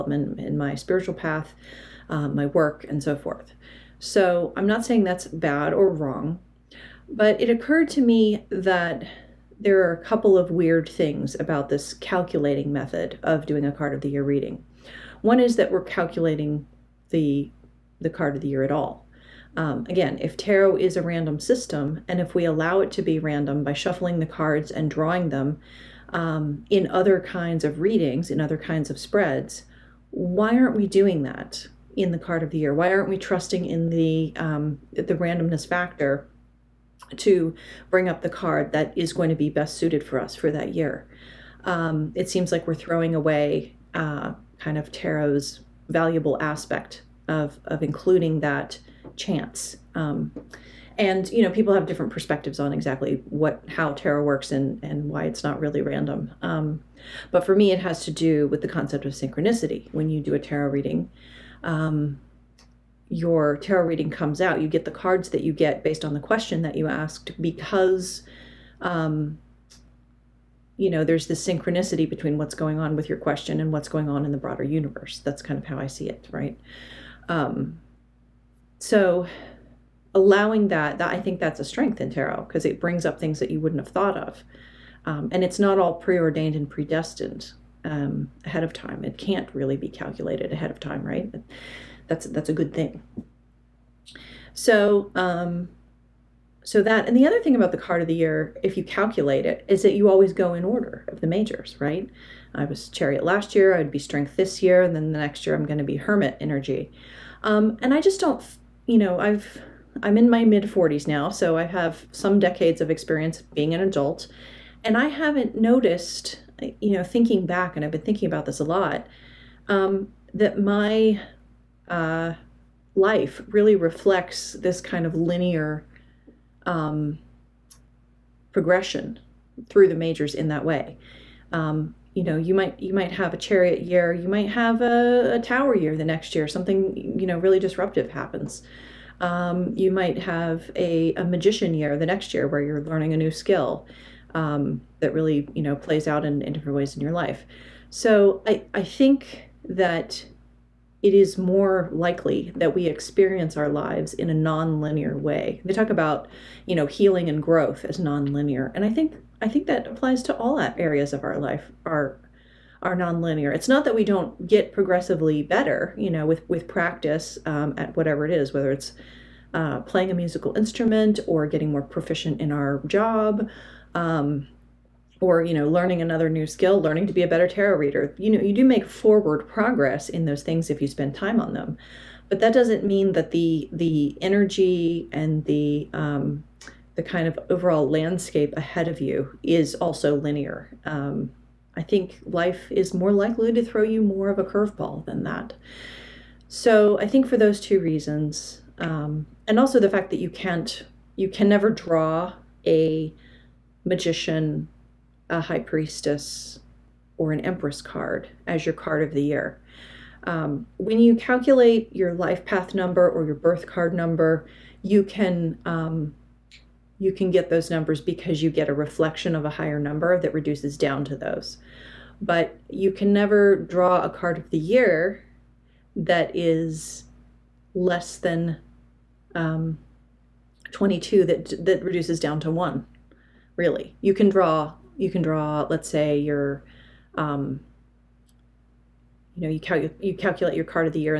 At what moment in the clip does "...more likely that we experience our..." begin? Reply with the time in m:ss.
2:31.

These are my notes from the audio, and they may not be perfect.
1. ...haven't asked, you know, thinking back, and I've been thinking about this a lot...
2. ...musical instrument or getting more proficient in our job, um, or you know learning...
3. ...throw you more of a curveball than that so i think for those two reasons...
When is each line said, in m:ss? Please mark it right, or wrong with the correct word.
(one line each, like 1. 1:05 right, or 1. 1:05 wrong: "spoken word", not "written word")
1. 1:55 wrong: "noticed", not "asked"
2. 2:50 right
3. 3:13 right.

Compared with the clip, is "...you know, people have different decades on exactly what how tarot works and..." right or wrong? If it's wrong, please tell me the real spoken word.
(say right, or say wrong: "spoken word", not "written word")
wrong: "perspectives", not "decades".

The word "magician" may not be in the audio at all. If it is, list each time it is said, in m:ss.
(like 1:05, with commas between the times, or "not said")
2:21, 3:23.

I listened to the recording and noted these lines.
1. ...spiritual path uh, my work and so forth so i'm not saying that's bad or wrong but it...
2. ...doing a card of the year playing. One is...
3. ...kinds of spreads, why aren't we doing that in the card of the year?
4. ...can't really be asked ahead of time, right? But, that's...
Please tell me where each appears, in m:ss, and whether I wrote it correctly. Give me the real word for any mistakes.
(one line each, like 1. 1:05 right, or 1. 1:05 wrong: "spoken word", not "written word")
1. 0:00 right
2. 0:13 wrong: "reading", not "playing"
3. 0:28 right
4. 1:29 wrong: "calculated", not "asked".